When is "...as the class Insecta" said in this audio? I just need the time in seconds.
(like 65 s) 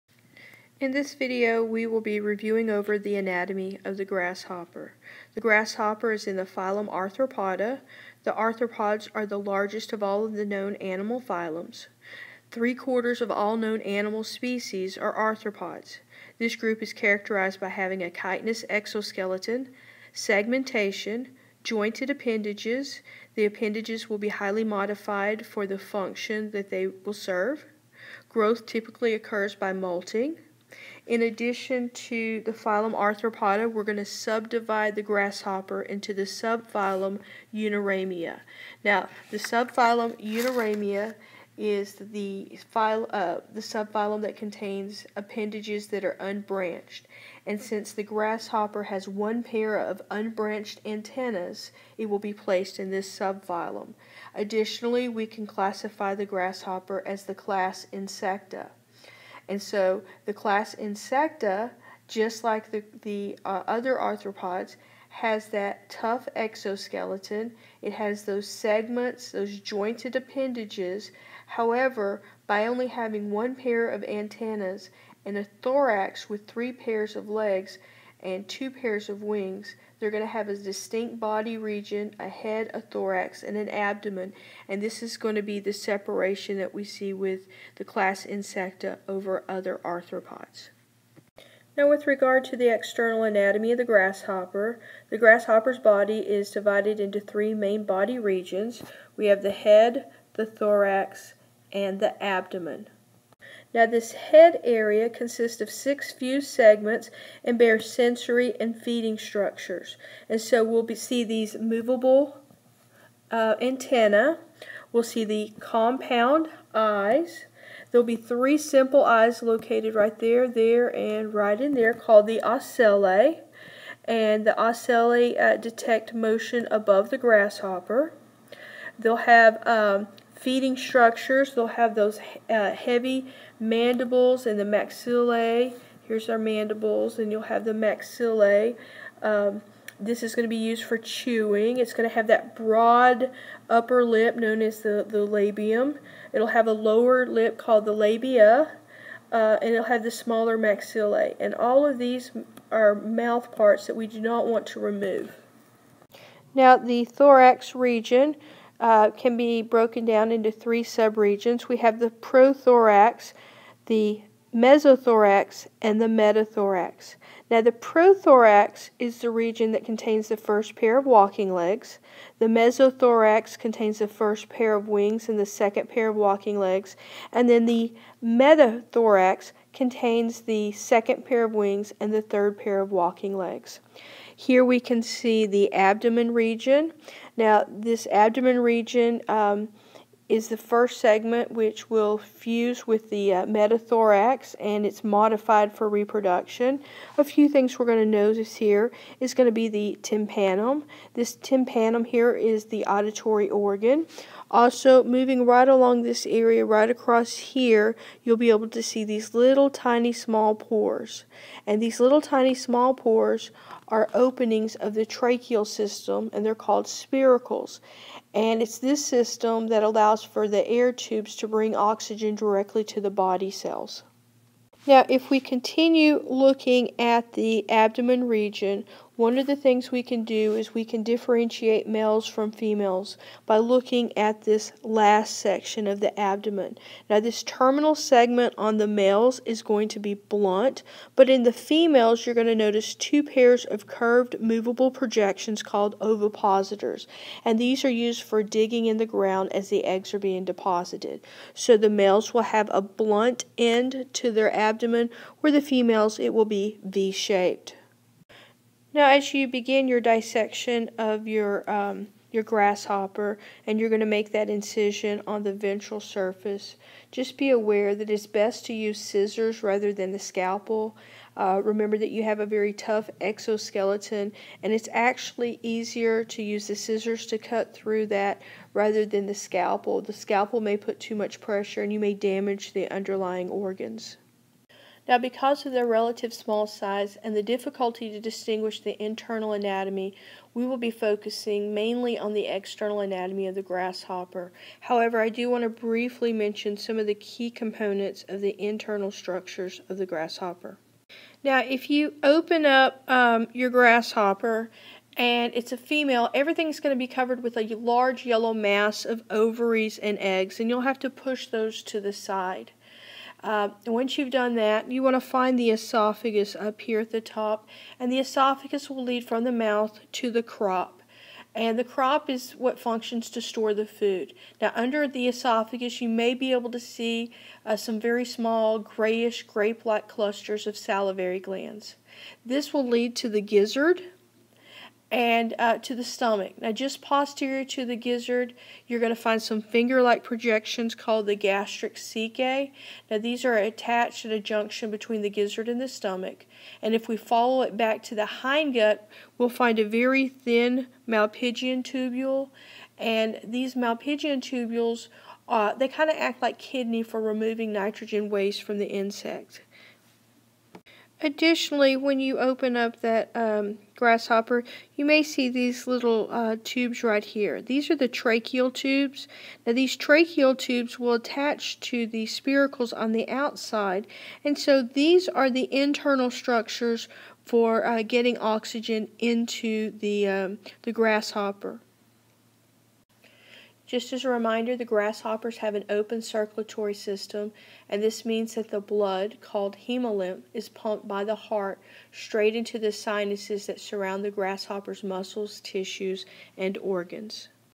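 57 s.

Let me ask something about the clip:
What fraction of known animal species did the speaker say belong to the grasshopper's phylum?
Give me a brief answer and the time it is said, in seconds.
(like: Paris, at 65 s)
Three quarters, at 12 s.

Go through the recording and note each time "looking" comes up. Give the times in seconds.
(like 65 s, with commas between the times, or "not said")
226 s, 233 s.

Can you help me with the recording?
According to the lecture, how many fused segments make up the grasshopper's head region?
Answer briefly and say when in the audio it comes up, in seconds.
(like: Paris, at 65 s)
6, at 105 s.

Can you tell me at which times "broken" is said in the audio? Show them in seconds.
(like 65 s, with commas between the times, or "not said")
159 s.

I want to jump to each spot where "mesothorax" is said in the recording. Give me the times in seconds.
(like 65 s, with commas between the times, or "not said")
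164 s, 172 s.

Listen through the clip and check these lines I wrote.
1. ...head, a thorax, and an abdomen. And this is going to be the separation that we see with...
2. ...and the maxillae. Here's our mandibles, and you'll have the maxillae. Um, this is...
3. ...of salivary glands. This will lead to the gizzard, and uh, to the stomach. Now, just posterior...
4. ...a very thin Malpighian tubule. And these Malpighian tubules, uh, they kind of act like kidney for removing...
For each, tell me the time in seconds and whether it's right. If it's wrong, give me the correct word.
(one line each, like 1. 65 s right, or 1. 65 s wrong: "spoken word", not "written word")
1. 82 s right
2. 134 s right
3. 330 s right
4. 349 s right.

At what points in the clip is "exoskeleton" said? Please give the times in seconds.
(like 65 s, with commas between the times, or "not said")
18 s, 66 s, 273 s.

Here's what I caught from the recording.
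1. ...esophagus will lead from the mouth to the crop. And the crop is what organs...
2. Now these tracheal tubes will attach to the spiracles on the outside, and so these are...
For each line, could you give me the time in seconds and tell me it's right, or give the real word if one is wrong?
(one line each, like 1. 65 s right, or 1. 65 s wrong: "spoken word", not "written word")
1. 318 s wrong: "functions", not "organs"
2. 369 s right.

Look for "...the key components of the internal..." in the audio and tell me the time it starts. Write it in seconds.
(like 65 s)
297 s.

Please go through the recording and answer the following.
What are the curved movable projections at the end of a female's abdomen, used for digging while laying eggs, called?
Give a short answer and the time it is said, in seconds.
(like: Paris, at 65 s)
Ovipositors, at 246 s.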